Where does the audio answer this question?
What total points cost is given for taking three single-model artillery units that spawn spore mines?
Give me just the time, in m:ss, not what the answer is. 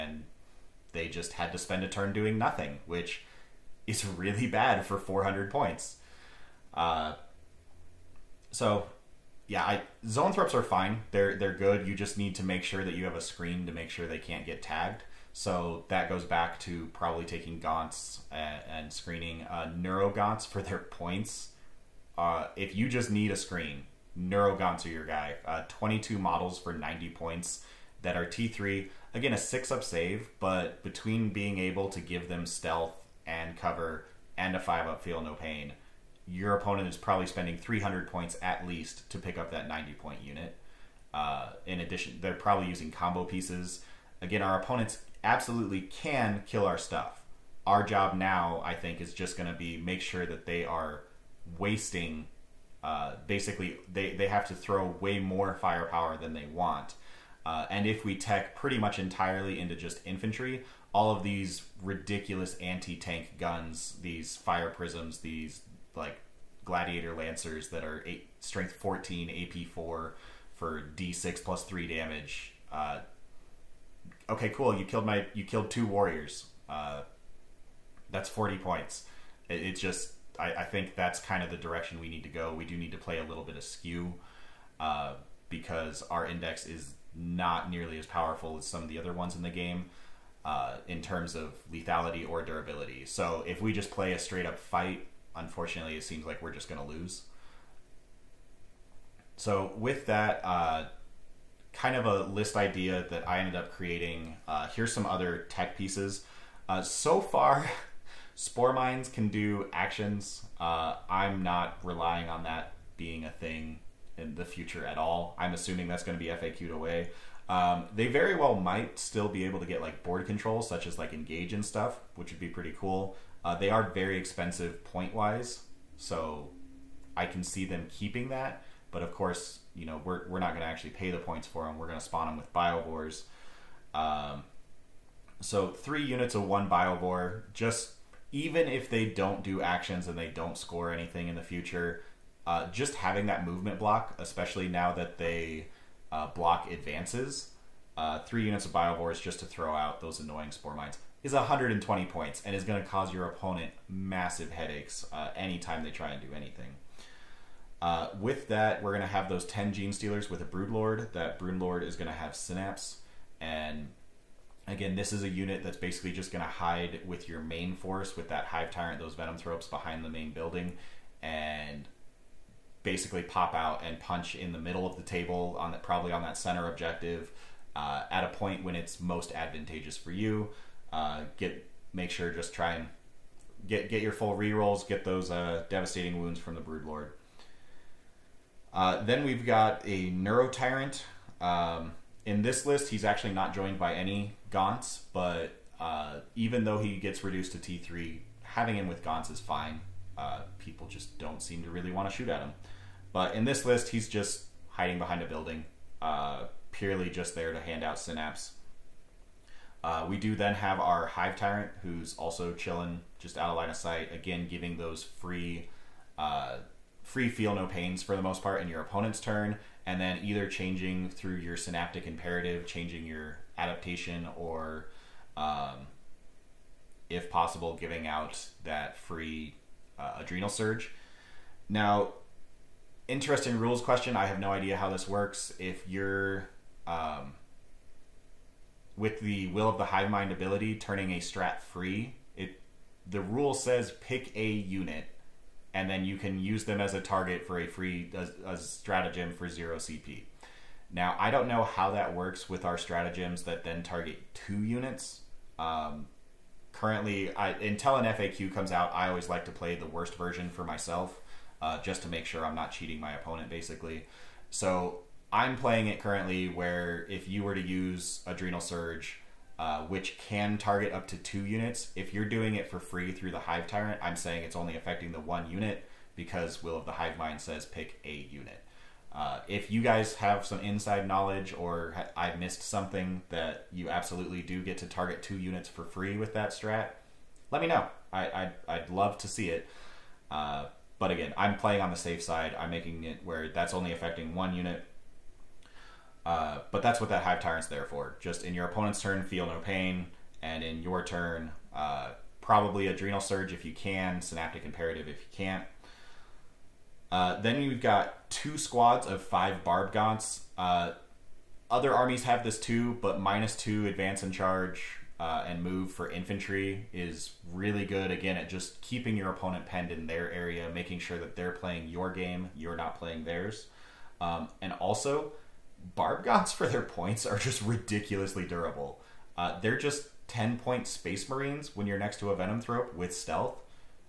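2:31.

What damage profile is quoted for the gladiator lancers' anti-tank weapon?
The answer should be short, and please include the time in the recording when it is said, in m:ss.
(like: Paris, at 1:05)
D6 plus 3, at 1:10.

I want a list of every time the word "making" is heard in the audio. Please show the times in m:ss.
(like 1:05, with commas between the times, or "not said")
4:52, 5:20.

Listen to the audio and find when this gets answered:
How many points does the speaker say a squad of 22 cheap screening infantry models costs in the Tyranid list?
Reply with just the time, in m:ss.
0:26.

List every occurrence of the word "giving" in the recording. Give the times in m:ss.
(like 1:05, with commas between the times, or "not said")
3:34, 3:47.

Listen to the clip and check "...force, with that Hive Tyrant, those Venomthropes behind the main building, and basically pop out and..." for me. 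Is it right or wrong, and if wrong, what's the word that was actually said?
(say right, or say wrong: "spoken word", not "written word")
right.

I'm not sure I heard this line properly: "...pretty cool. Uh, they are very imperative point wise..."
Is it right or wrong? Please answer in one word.
wrong.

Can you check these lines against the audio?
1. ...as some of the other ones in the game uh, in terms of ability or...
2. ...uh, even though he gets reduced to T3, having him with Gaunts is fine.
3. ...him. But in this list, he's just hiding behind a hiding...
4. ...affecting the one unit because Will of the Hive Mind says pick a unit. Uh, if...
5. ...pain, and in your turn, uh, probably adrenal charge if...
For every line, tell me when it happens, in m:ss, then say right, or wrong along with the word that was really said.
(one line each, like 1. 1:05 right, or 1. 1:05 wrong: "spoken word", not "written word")
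1. 1:28 wrong: "lethality", not "ability"
2. 3:15 right
3. 3:22 wrong: "building", not "hiding"
4. 4:34 right
5. 4:59 wrong: "surge", not "charge".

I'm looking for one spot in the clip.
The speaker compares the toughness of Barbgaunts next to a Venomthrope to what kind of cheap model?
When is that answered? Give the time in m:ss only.
5:30.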